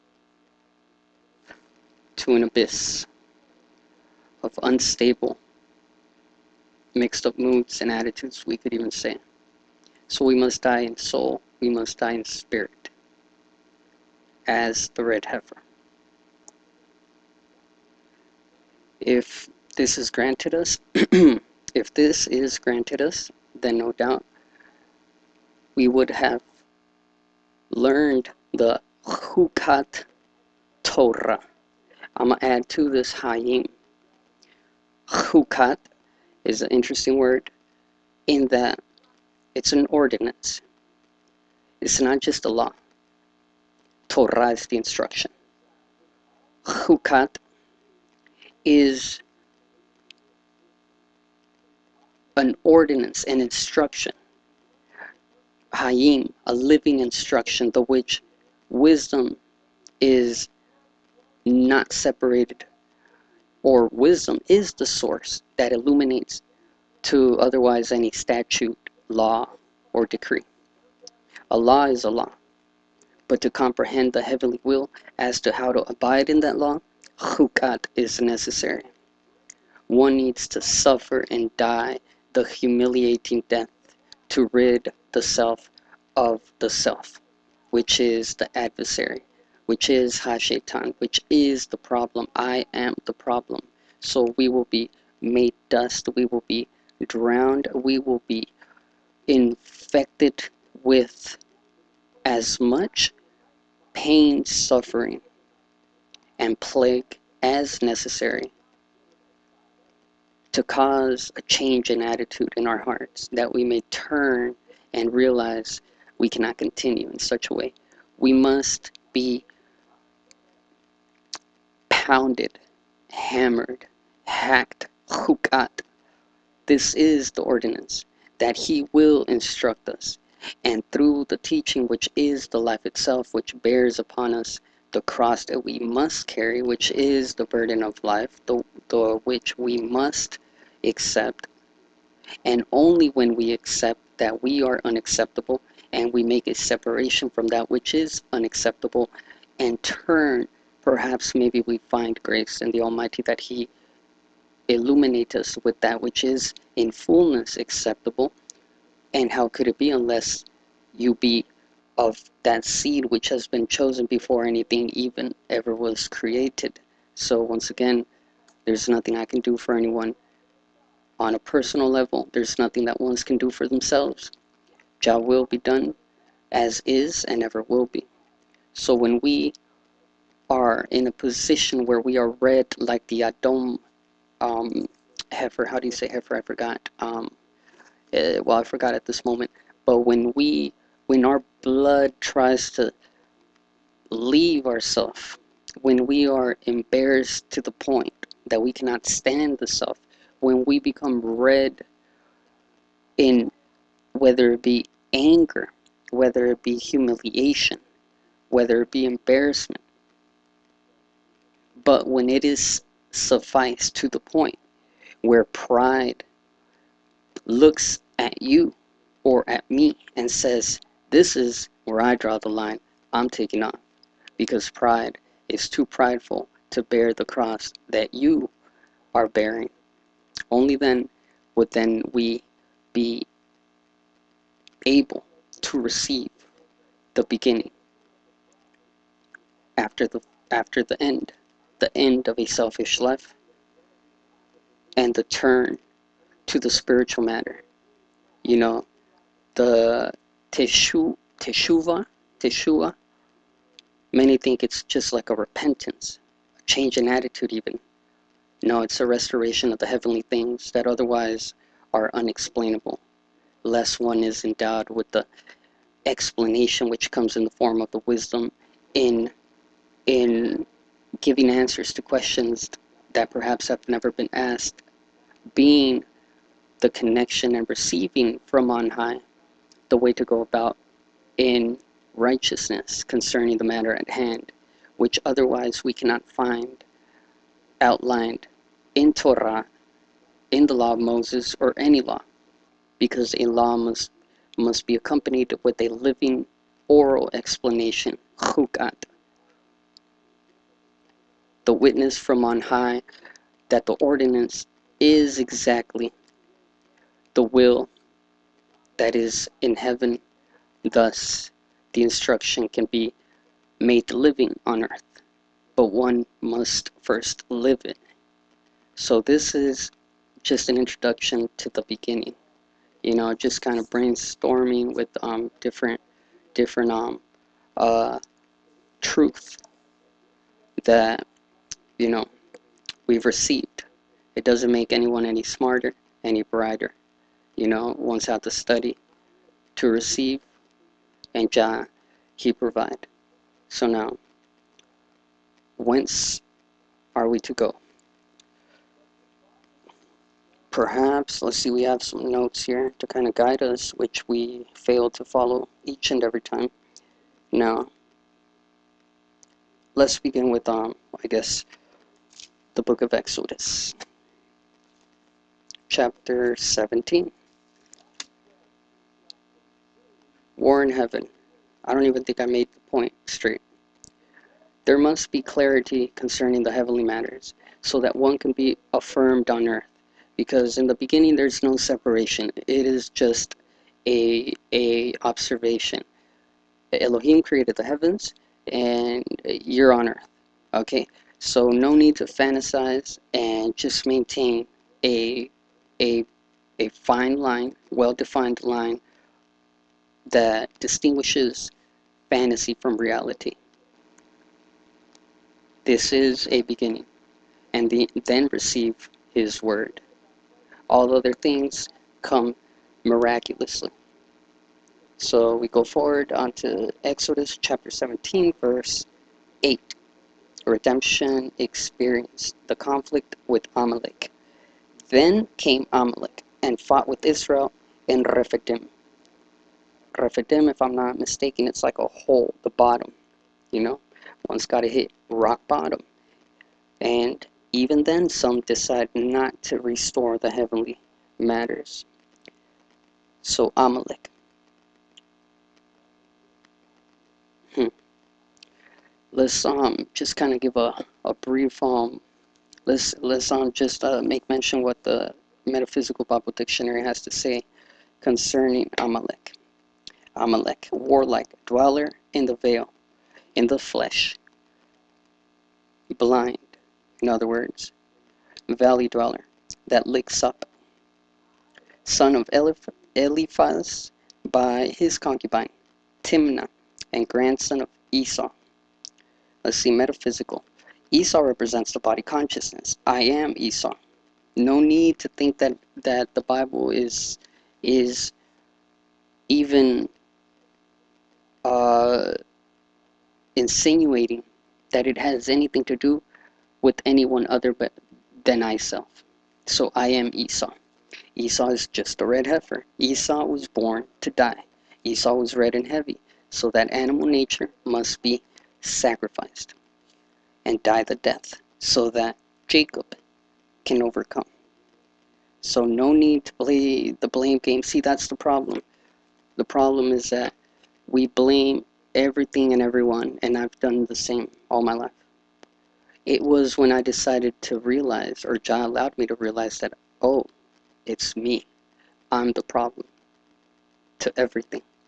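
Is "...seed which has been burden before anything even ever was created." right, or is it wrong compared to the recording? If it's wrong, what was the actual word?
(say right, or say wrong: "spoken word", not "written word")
wrong: "chosen", not "burden".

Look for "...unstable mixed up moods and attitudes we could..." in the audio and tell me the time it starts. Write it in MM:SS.
00:04.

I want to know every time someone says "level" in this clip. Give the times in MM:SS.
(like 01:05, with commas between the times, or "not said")
02:51.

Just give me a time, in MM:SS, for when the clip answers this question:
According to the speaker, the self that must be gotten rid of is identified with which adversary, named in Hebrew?
01:30.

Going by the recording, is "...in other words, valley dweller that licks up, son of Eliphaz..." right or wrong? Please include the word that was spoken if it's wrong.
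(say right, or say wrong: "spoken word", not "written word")
right.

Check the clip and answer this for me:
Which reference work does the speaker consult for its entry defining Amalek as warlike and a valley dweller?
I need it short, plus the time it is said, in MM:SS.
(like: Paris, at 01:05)
Metaphysical Bible Dictionary, at 07:35.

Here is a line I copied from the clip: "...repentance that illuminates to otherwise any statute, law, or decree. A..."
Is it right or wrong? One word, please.
wrong.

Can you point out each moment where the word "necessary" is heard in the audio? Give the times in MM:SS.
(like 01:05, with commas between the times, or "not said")
01:18, 01:47.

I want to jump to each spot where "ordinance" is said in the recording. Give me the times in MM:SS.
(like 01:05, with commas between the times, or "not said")
00:39, 00:52, 02:07, 05:03.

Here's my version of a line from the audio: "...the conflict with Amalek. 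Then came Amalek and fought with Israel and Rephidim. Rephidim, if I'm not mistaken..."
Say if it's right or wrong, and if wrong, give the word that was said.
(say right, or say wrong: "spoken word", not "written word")
right.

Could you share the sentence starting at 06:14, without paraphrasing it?
There must be clarity concerning the heavenly matters, so that one can be affirmed on earth.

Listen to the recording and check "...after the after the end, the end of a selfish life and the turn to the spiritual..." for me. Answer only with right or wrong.
right.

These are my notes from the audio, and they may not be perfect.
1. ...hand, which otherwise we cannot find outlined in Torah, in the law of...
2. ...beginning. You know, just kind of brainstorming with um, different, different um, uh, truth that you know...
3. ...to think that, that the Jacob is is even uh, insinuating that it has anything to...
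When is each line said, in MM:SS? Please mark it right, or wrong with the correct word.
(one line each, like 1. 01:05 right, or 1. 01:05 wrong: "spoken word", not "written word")
1. 04:44 right
2. 05:21 right
3. 08:05 wrong: "Bible", not "Jacob".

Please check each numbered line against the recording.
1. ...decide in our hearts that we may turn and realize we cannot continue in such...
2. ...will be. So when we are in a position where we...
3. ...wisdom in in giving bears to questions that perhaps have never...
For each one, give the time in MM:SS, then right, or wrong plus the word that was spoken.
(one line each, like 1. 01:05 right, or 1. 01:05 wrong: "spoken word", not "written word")
1. 01:52 wrong: "attitude", not "decide"
2. 02:57 right
3. 04:28 wrong: "answers", not "bears".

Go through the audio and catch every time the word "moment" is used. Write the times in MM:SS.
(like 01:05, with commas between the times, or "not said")
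03:09.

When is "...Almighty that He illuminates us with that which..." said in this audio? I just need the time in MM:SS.
02:32.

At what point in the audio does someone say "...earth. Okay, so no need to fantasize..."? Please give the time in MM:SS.
06:30.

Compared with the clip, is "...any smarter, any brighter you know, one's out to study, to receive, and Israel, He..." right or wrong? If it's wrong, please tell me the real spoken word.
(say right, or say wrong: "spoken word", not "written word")
wrong: "Jah", not "Israel".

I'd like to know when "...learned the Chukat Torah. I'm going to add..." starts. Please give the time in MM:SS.
00:27.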